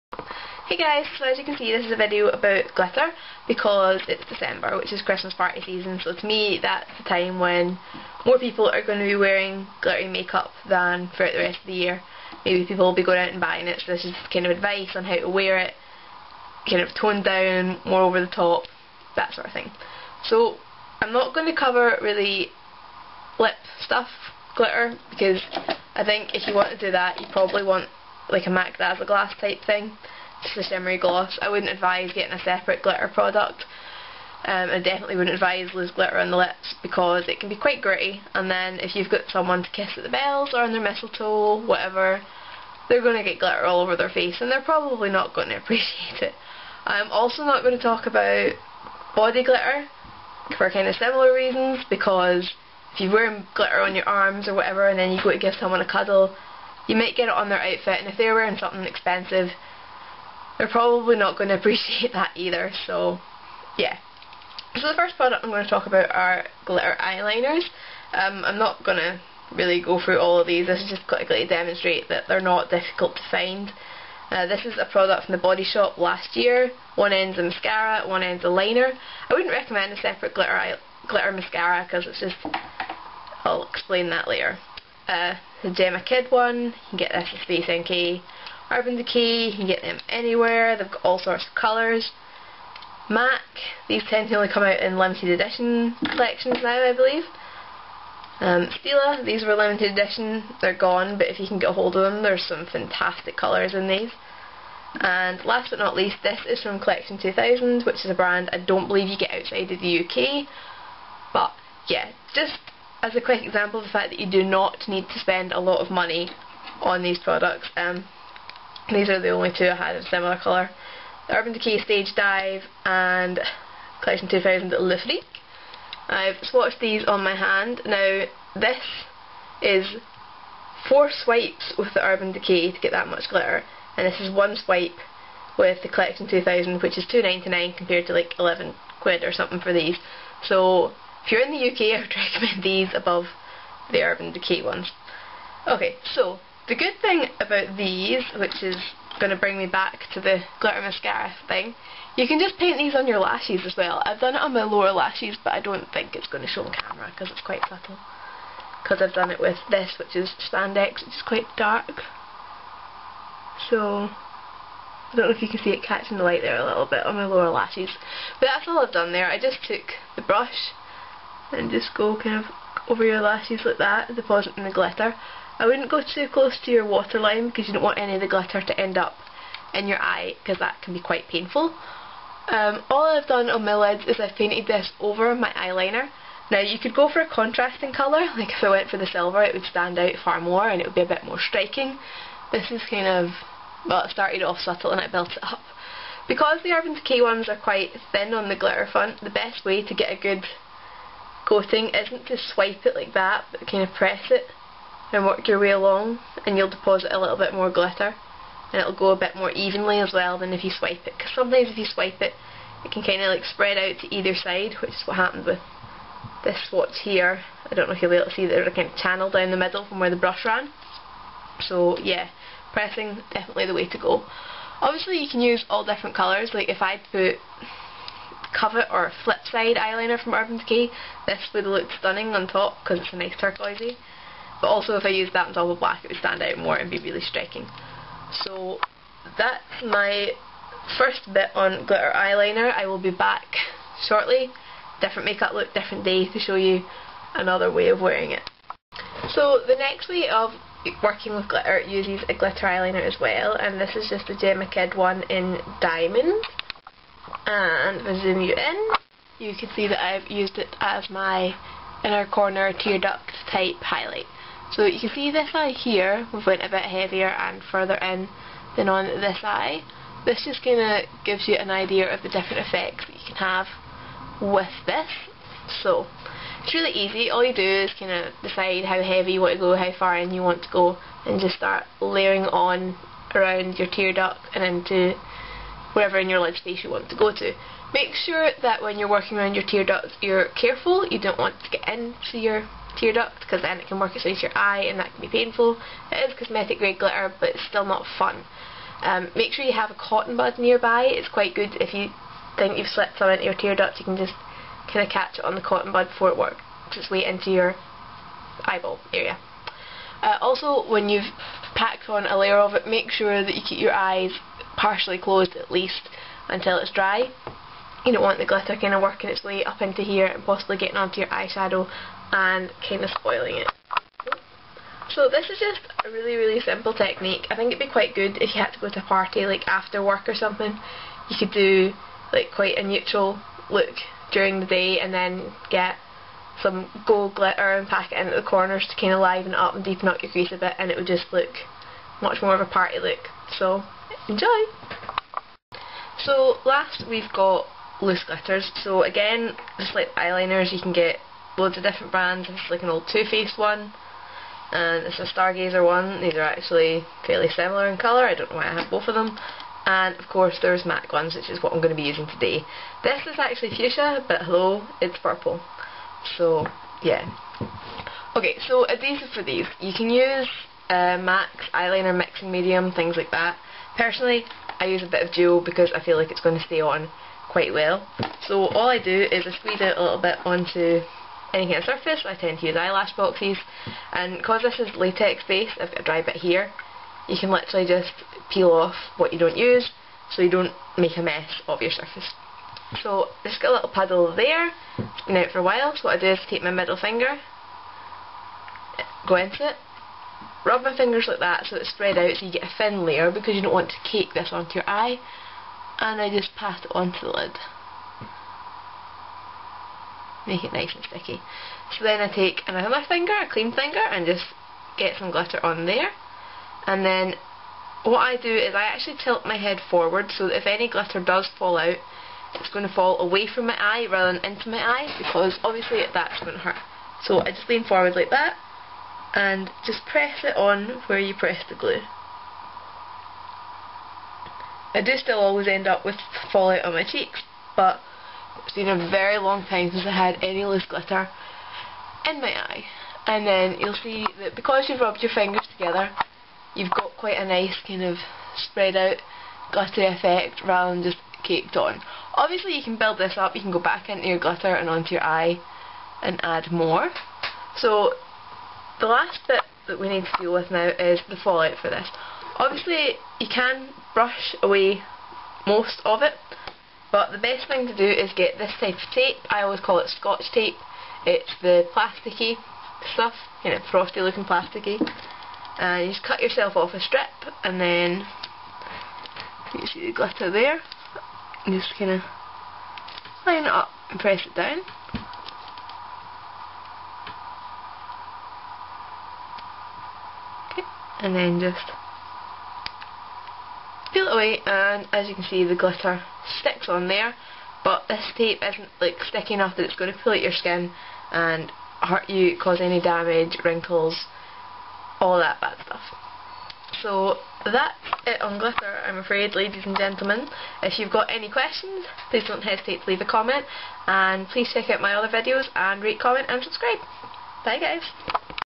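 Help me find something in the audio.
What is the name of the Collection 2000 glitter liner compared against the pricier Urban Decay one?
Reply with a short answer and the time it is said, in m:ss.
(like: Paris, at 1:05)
Le Freak, at 2:04.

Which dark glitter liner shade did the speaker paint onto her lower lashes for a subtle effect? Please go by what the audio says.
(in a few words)
Spandex.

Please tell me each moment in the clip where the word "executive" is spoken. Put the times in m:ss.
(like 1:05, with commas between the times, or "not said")
not said.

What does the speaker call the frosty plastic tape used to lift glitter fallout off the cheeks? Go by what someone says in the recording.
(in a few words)
Scotch tape.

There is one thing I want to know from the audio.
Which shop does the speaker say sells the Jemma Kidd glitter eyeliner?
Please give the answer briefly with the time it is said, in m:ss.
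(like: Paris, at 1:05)
Space NK, at 1:27.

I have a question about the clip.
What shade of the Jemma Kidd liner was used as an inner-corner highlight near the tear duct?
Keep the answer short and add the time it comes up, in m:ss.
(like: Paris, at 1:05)
Diamond, at 4:15.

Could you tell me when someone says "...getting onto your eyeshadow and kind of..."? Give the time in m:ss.
5:20.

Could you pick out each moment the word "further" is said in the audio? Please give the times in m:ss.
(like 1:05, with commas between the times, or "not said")
4:27.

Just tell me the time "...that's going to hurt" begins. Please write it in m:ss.
7:06.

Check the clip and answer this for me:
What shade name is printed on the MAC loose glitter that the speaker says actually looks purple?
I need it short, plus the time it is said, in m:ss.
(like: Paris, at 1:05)
Fuchsia, at 6:03.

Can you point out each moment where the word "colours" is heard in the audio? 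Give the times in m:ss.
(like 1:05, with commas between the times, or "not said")
1:31, 1:43, 2:00, 3:07, 3:46, 5:57.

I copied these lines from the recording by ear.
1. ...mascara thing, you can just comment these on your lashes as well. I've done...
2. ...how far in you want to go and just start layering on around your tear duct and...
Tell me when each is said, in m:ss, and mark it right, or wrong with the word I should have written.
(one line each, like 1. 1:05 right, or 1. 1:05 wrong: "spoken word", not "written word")
1. 2:30 wrong: "paint", not "comment"
2. 4:39 right.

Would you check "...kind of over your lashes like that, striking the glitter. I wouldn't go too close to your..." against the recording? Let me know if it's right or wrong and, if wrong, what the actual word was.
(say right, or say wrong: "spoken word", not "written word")
wrong: "depositing", not "striking".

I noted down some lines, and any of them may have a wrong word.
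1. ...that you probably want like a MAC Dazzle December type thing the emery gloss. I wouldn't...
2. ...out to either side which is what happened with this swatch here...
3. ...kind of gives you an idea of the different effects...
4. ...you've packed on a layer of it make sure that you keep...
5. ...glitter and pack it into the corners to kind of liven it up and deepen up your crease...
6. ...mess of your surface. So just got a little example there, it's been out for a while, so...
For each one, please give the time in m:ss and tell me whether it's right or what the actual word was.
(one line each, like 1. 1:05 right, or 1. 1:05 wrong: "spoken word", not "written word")
1. 0:26 wrong: "Glass", not "December"
2. 3:33 right
3. 4:30 right
4. 5:11 right
5. 5:37 right
6. 6:31 wrong: "puddle", not "example".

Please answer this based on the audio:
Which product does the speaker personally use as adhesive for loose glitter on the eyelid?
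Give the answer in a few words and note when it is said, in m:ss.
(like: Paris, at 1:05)
Duo, at 6:15.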